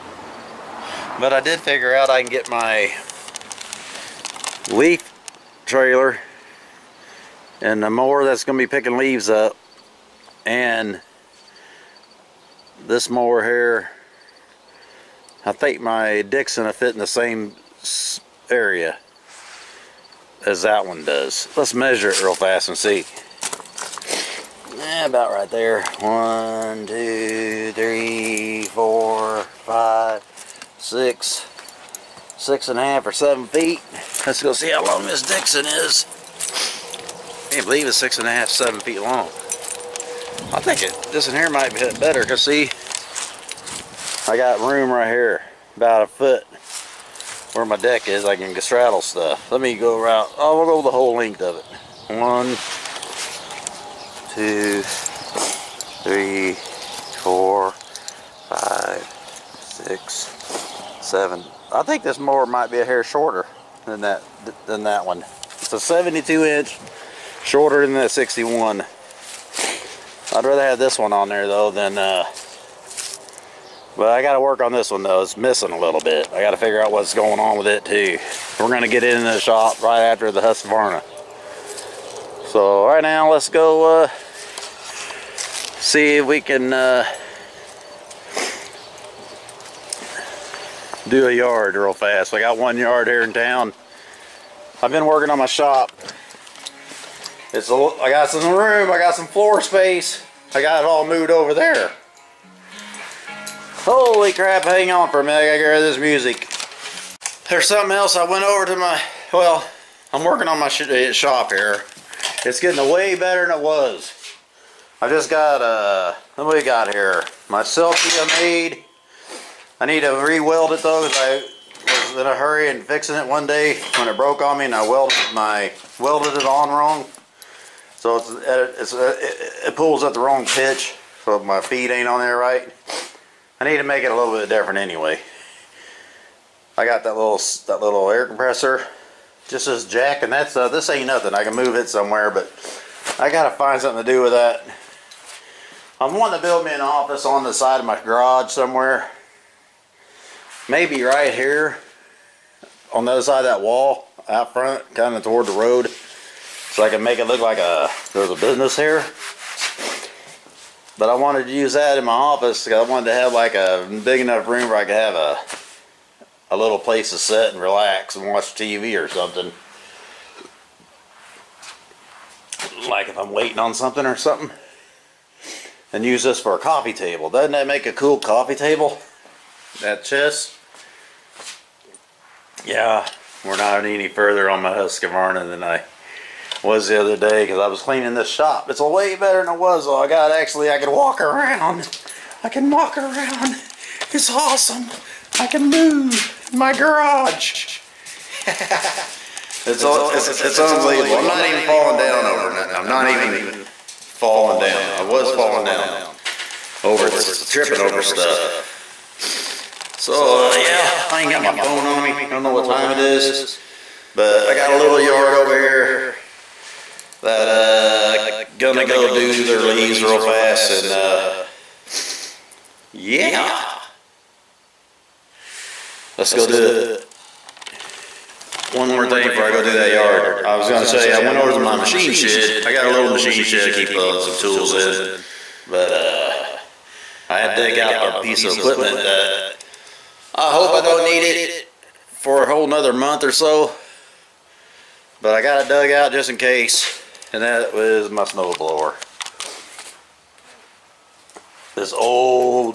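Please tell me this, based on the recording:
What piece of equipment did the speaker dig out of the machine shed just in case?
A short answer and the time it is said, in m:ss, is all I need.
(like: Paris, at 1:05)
Snowblower, at 4:08.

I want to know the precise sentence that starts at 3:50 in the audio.
I was gonna say, I went over to my machine shed.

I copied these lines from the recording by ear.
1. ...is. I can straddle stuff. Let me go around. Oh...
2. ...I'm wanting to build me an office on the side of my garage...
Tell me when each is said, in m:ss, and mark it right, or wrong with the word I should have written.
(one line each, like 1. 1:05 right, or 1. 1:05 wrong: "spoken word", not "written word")
1. 0:48 right
2. 2:26 right.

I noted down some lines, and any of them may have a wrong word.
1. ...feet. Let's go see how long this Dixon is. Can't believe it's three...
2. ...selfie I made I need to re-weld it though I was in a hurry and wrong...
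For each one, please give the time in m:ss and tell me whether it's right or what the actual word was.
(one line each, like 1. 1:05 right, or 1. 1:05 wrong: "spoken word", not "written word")
1. 0:33 wrong: "six", not "three"
2. 1:57 wrong: "fixing", not "wrong".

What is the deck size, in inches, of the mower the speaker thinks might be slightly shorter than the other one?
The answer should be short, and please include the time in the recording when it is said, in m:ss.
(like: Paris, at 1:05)
72, at 1:05.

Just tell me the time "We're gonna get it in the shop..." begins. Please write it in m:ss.
1:18.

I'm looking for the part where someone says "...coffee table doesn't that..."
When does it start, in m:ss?
2:56.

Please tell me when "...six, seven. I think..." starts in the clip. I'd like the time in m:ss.
0:59.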